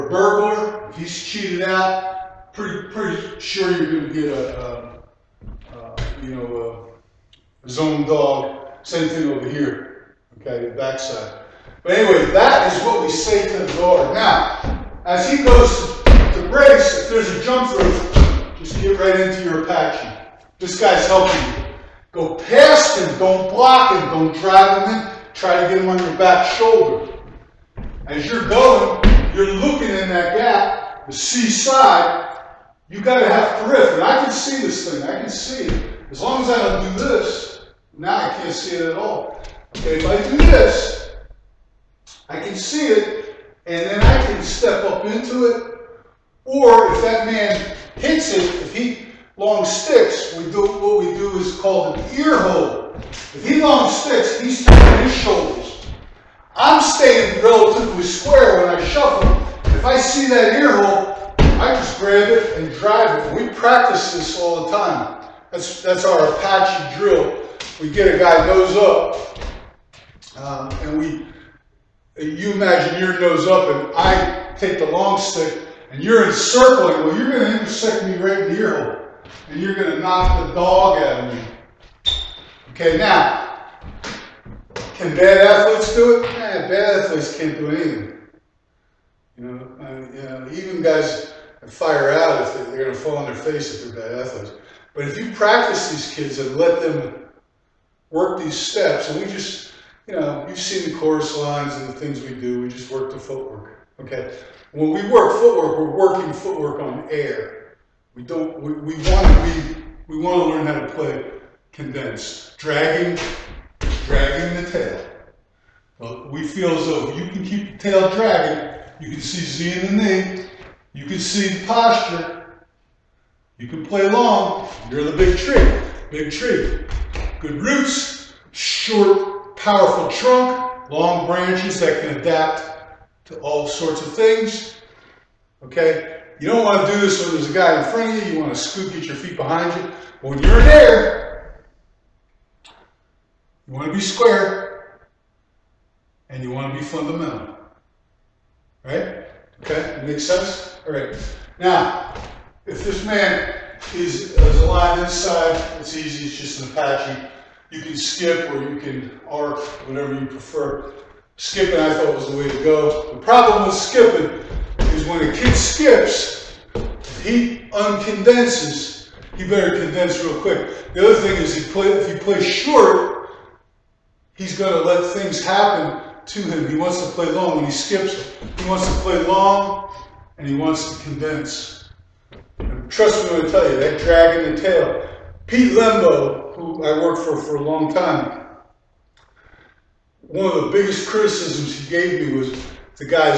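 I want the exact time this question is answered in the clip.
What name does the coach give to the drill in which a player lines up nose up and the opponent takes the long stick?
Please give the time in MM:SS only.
01:06.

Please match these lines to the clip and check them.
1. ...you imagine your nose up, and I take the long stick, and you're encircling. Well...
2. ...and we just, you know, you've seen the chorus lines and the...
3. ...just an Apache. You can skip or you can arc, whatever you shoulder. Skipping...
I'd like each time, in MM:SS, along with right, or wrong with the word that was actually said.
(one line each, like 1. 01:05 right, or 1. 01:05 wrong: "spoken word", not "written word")
1. 01:12 right
2. 01:39 right
3. 02:36 wrong: "prefer", not "shoulder".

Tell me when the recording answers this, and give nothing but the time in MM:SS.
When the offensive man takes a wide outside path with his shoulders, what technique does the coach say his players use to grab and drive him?
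00:52.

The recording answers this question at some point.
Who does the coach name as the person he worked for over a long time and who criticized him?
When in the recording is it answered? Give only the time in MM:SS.
03:05.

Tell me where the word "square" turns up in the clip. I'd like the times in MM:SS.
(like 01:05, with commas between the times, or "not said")
00:58, 02:24.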